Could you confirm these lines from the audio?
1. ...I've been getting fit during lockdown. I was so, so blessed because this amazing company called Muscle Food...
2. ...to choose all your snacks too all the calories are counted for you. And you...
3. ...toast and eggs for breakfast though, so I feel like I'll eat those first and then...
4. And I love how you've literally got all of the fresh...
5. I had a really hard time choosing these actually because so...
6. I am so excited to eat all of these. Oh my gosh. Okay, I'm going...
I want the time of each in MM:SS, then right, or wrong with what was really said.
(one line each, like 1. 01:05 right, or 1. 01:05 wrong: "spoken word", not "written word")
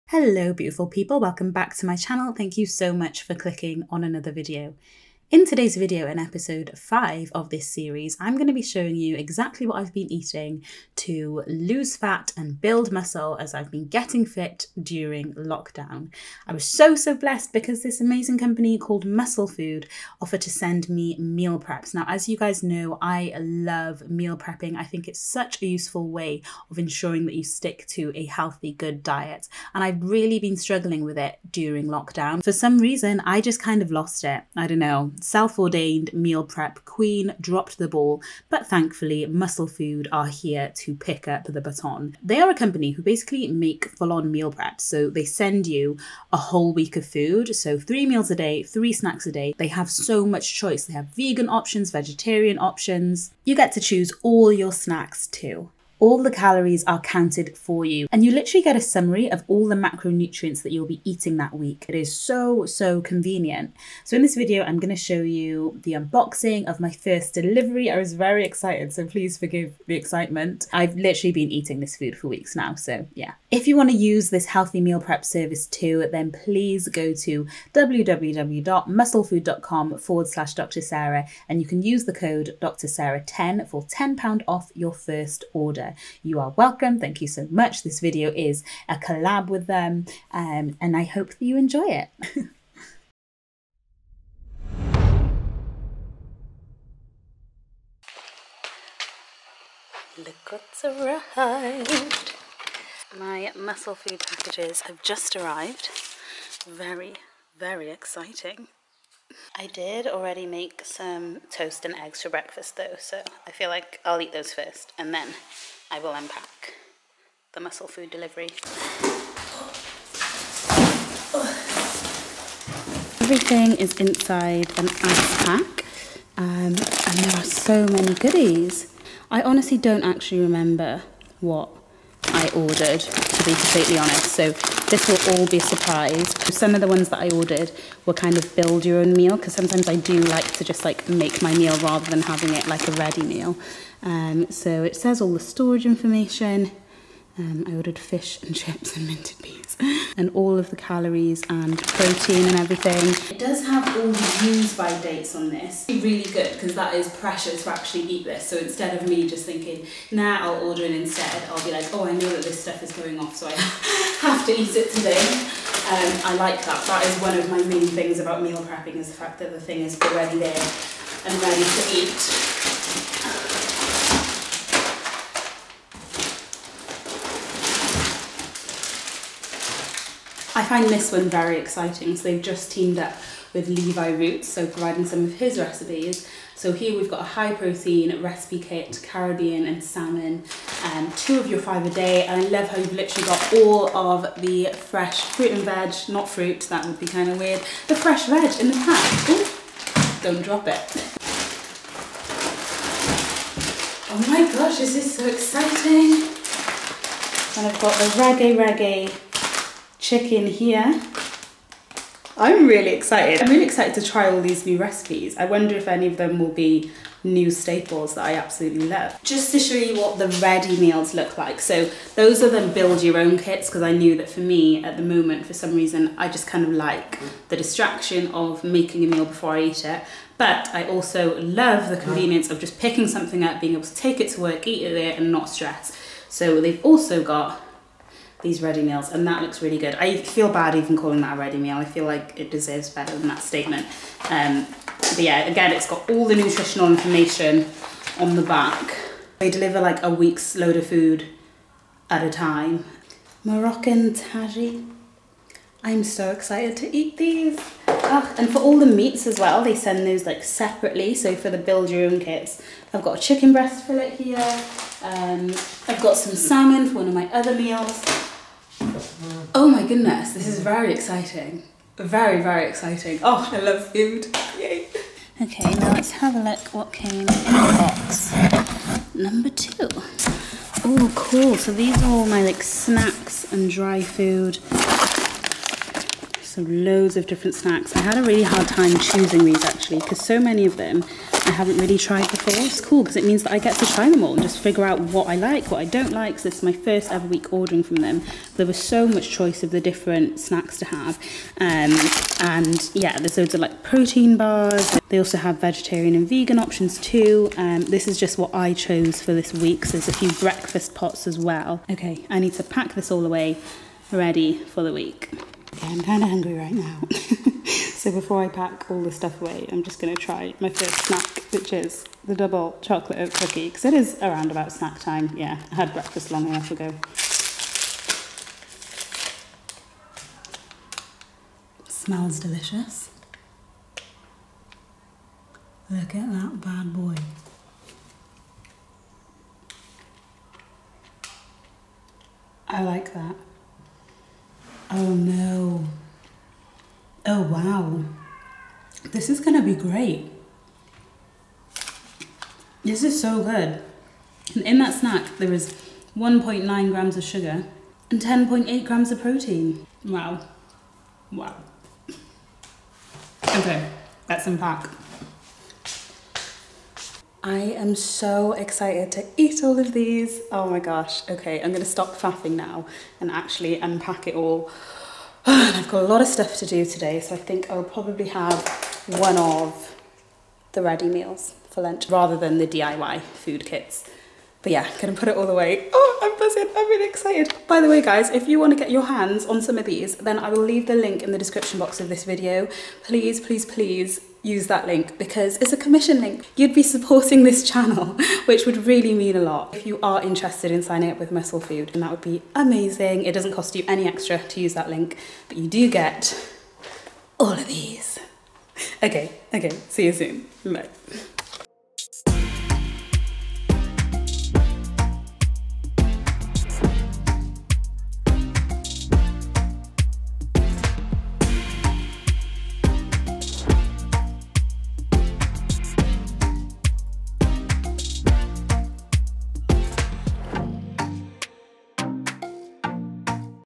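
1. 00:13 right
2. 00:53 right
3. 01:51 right
4. 03:12 right
5. 04:47 right
6. 06:07 right.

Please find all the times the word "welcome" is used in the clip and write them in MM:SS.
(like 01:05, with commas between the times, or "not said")
00:01, 01:26.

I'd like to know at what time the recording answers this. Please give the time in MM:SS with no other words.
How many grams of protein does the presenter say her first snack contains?
05:58.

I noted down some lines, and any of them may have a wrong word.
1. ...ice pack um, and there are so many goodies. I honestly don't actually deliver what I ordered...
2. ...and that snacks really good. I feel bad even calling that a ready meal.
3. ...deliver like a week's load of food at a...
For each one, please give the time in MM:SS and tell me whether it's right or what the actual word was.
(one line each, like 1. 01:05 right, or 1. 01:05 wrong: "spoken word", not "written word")
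1. 02:04 wrong: "remember", not "deliver"
2. 03:59 wrong: "looks", not "snacks"
3. 04:09 right.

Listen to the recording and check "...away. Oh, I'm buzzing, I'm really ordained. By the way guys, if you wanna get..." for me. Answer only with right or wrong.
wrong.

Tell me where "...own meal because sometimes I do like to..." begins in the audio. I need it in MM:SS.
02:18.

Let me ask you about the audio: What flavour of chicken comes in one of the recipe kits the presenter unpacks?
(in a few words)
reggae reggae.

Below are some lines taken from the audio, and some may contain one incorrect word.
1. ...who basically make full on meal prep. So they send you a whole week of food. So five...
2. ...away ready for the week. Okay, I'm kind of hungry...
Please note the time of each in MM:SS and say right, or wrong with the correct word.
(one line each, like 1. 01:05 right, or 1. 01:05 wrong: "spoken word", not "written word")
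1. 00:42 wrong: "three", not "five"
2. 05:13 right.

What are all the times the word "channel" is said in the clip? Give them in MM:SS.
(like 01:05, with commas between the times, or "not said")
00:01, 06:37.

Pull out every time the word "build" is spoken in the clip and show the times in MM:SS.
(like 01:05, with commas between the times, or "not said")
00:12, 02:18, 03:42, 04:21.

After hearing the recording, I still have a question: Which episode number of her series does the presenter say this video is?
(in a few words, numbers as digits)
5.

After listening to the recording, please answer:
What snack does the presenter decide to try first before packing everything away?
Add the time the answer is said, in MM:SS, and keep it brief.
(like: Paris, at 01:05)
double chocolate oat cookie, at 05:22.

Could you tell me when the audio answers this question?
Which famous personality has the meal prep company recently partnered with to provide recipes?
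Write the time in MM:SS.
03:03.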